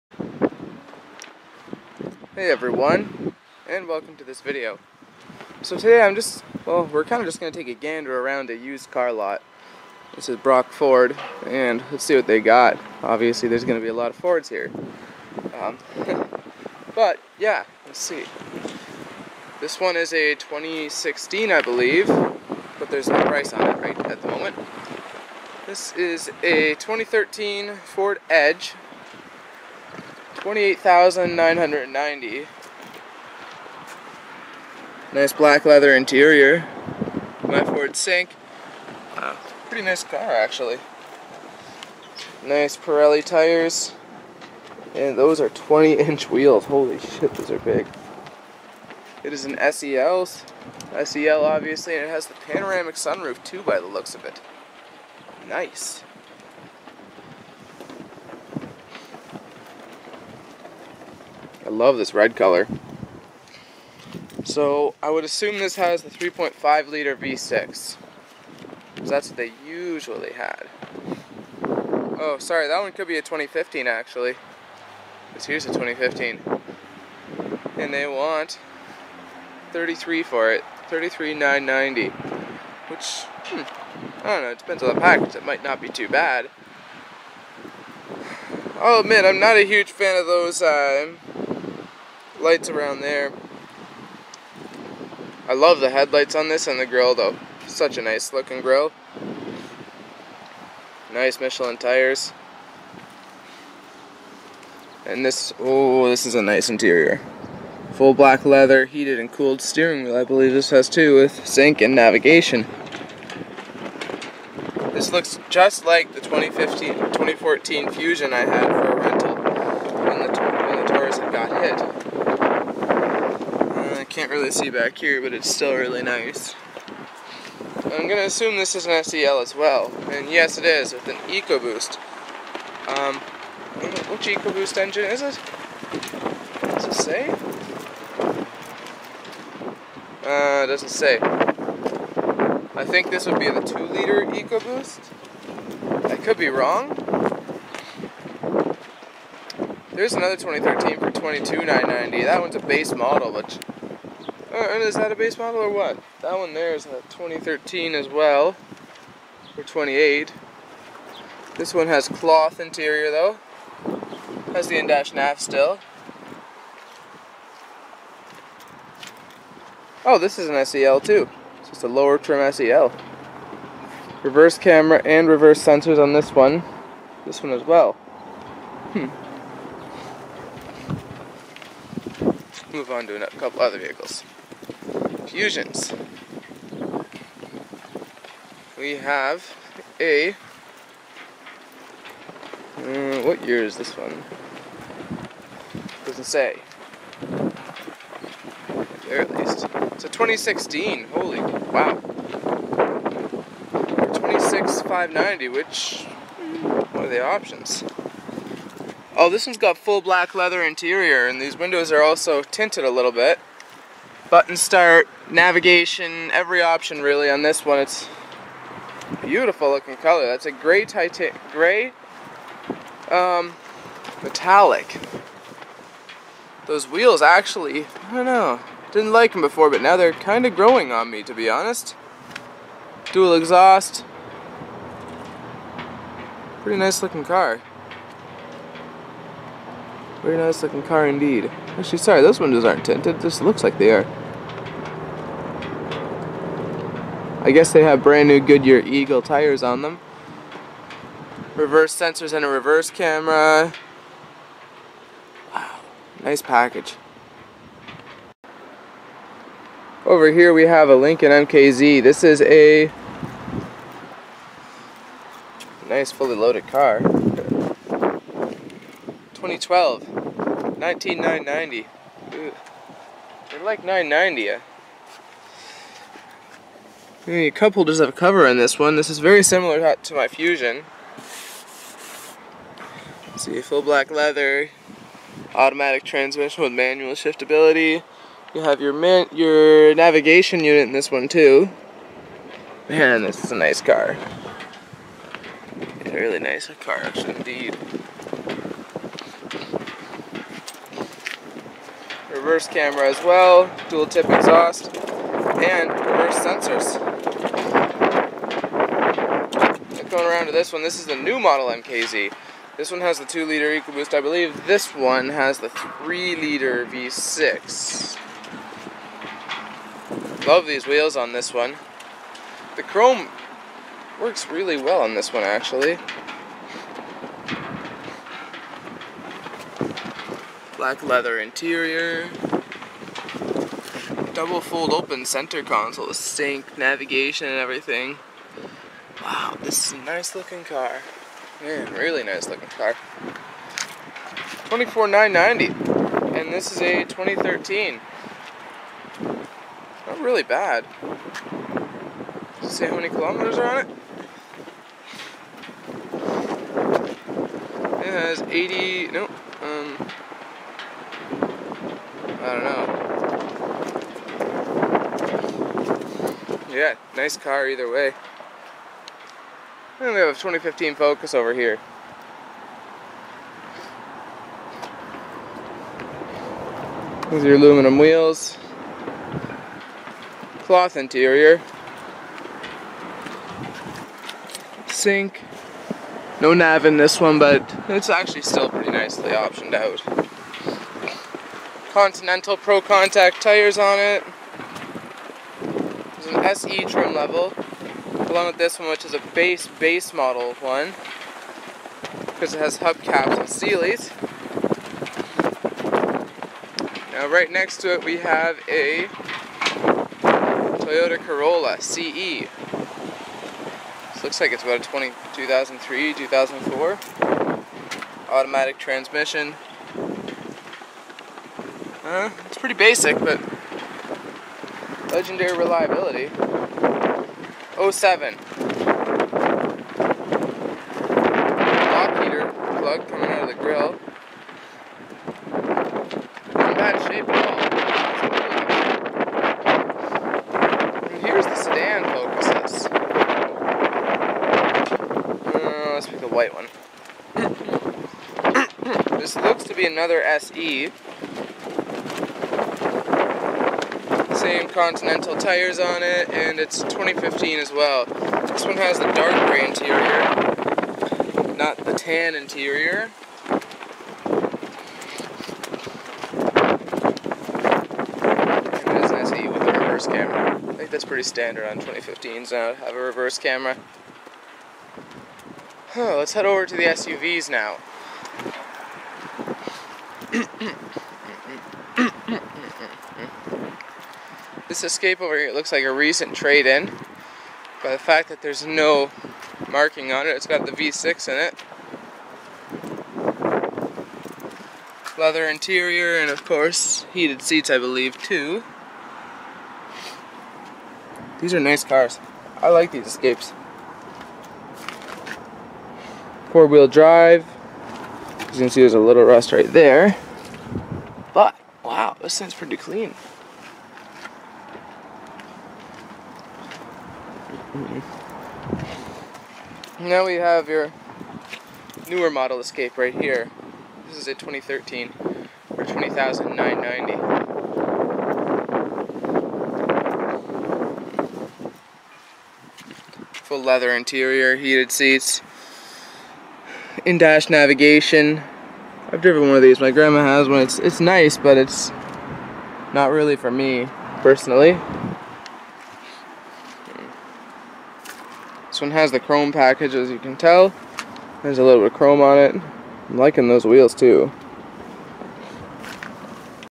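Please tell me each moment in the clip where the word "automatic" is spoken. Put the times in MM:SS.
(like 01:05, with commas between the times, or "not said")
04:45, 06:58.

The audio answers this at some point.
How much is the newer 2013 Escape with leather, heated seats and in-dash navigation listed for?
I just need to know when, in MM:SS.
08:45.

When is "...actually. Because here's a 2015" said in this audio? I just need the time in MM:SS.
01:13.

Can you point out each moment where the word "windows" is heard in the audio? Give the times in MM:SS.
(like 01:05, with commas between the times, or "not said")
03:31, 04:02.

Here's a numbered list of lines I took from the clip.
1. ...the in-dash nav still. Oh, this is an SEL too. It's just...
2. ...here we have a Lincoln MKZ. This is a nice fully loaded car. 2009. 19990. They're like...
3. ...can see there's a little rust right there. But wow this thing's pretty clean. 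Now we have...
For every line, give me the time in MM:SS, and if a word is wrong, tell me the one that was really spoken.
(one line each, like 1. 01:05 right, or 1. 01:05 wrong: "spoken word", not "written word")
1. 02:44 right
2. 04:20 wrong: "2012", not "2009"
3. 08:28 right.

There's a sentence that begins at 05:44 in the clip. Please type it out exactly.
24990 and this is a 2013.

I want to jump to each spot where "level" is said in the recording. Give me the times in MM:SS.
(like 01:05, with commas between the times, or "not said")
06:37.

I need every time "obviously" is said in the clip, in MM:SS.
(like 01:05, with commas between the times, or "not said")
00:13, 00:51.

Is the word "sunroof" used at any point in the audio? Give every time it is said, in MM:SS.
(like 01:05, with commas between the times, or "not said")
00:52.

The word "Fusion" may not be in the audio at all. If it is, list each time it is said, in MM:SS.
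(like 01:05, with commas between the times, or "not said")
01:57, 03:05, 04:40.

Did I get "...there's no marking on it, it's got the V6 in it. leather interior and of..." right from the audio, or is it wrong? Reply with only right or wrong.
right.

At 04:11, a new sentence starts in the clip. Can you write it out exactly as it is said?
Reverse sensors and a reverse camera.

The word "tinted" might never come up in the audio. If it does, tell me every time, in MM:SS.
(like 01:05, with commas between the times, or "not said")
03:32, 04:02.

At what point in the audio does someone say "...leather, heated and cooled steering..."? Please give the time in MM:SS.
01:48.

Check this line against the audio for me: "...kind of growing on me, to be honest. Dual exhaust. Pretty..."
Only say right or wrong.
right.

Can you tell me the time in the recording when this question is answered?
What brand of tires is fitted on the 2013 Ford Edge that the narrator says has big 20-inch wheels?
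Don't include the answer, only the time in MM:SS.
00:42.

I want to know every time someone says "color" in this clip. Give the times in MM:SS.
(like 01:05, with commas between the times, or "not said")
01:02, 03:39.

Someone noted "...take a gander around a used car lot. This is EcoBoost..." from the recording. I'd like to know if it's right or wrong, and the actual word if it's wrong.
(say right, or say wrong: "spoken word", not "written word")
wrong: "Brock", not "EcoBoost".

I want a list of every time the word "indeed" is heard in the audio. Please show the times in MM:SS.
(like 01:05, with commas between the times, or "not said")
04:01, 04:57.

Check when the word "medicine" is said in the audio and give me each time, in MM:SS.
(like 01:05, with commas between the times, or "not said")
not said.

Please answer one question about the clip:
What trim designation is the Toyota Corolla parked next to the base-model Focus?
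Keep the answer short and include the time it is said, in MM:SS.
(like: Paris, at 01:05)
CE, at 06:51.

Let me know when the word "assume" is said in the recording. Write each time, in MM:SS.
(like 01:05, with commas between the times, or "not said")
01:05, 02:08.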